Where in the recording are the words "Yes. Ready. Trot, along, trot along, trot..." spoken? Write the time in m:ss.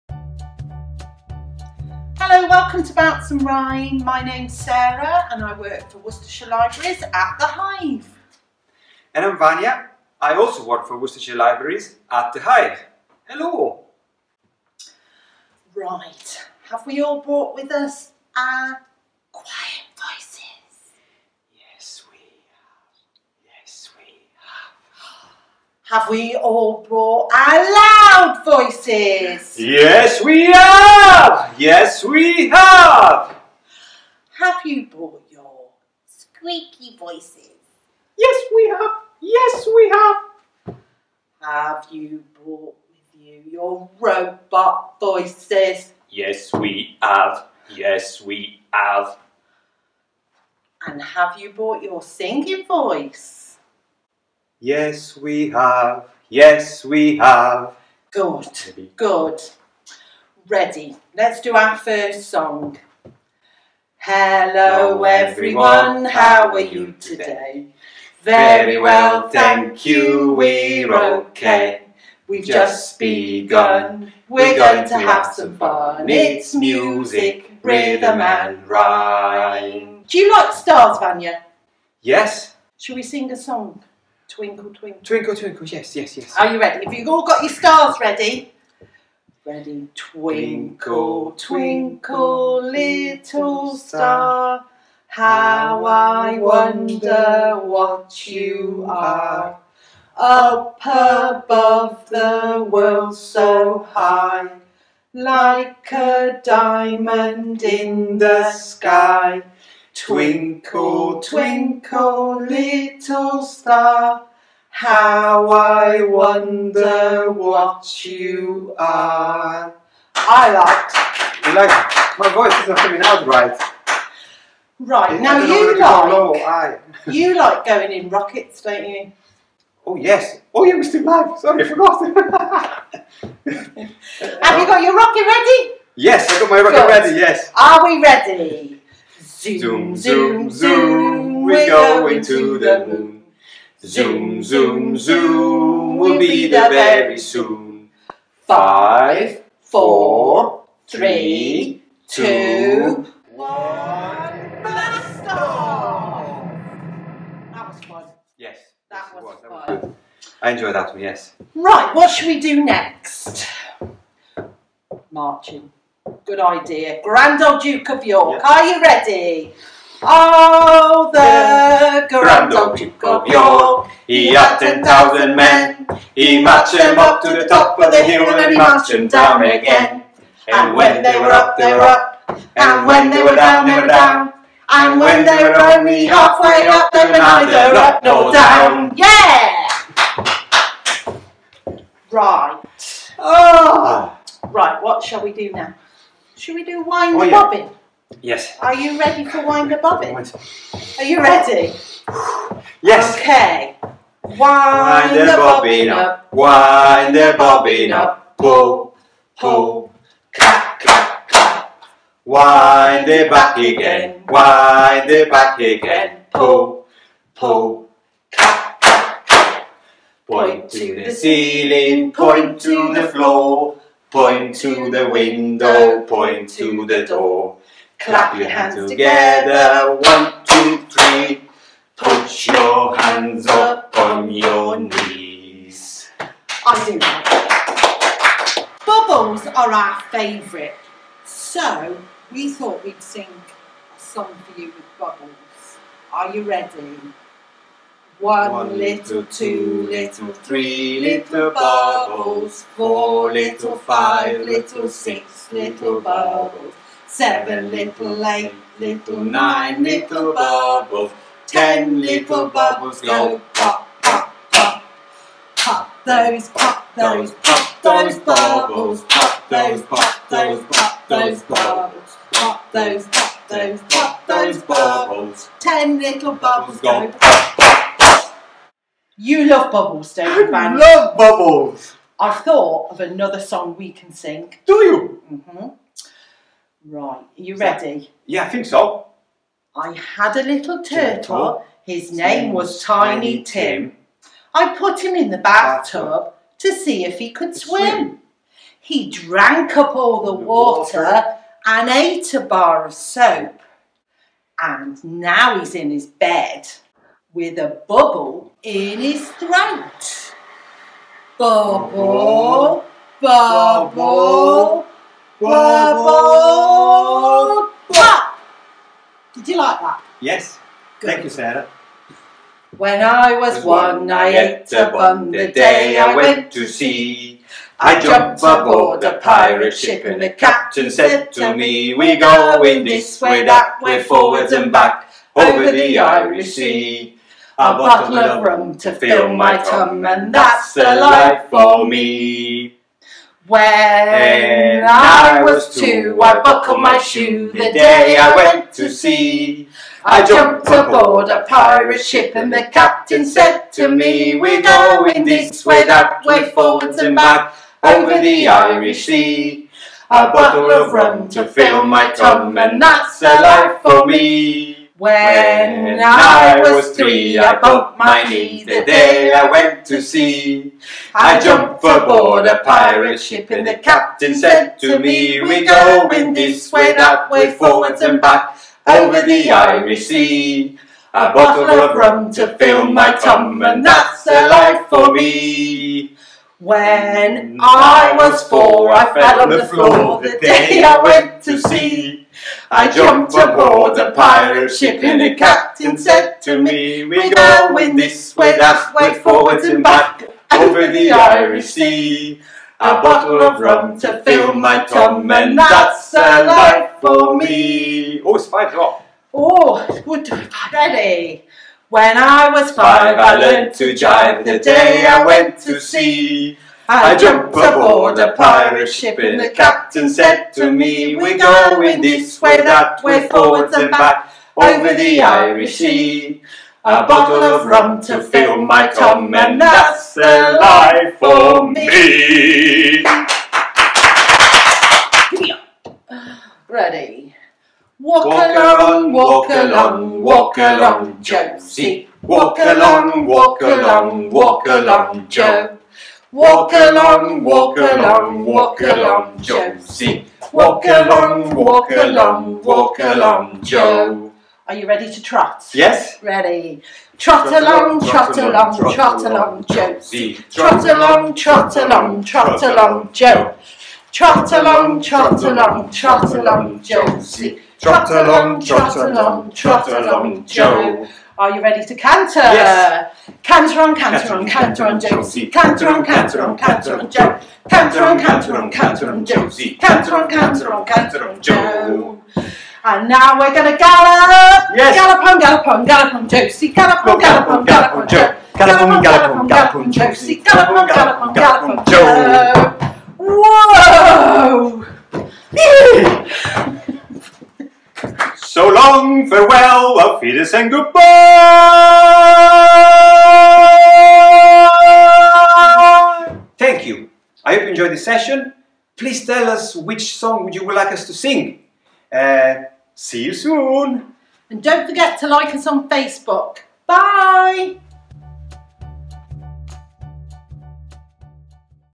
7:35.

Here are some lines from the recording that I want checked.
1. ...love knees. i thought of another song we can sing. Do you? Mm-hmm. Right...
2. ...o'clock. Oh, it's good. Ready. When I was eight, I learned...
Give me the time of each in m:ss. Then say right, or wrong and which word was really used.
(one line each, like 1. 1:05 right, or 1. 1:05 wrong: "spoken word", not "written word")
1. 4:40 wrong: "bubbles", not "knees"
2. 6:48 wrong: "five", not "eight".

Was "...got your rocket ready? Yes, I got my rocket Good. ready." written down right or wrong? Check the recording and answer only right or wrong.
right.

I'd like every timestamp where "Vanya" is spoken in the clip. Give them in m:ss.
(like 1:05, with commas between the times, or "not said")
0:09, 1:20.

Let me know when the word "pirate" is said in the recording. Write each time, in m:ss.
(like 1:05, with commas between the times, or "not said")
5:29, 5:51, 6:12, 6:34, 6:58.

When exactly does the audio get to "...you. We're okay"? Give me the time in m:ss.
1:09.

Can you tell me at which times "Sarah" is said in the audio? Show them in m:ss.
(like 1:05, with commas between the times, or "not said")
0:04, 5:21.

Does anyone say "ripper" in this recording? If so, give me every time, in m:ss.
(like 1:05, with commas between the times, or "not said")
not said.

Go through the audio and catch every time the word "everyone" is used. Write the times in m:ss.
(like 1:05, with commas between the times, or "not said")
1:05.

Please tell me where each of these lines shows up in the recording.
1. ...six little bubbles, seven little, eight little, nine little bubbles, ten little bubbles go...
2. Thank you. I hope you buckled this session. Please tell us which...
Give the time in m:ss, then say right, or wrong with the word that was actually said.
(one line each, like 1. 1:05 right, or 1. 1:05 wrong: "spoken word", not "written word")
1. 4:14 right
2. 8:26 wrong: "enjoyed", not "buckled".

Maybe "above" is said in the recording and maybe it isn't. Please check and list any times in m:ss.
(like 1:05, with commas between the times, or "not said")
1:40.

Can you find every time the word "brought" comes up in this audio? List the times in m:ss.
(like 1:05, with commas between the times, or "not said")
0:17, 0:26, 0:34, 0:42, 0:51.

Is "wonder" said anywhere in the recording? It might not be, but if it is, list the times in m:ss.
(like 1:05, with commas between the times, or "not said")
1:36, 1:56.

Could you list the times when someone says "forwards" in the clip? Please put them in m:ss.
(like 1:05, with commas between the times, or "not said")
5:34, 5:56, 6:17, 6:39, 7:03.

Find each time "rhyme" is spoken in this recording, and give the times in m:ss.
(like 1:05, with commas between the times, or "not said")
0:03, 1:18.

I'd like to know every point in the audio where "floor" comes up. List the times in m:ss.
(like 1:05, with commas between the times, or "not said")
3:43, 6:29.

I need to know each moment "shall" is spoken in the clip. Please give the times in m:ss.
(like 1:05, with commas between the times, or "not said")
1:22, 3:15.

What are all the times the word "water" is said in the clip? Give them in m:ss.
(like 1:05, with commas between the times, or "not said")
5:00.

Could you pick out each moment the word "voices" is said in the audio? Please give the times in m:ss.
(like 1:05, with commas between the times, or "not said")
0:28, 0:36, 0:44, 0:52, 2:02.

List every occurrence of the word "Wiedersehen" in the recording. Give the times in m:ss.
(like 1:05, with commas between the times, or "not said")
8:20.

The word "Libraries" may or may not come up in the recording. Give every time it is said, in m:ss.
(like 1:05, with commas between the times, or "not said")
0:06, 0:11.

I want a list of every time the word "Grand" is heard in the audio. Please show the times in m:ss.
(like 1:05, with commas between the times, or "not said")
2:47, 2:52.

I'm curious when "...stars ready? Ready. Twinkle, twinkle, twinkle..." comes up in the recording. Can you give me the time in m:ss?
1:27.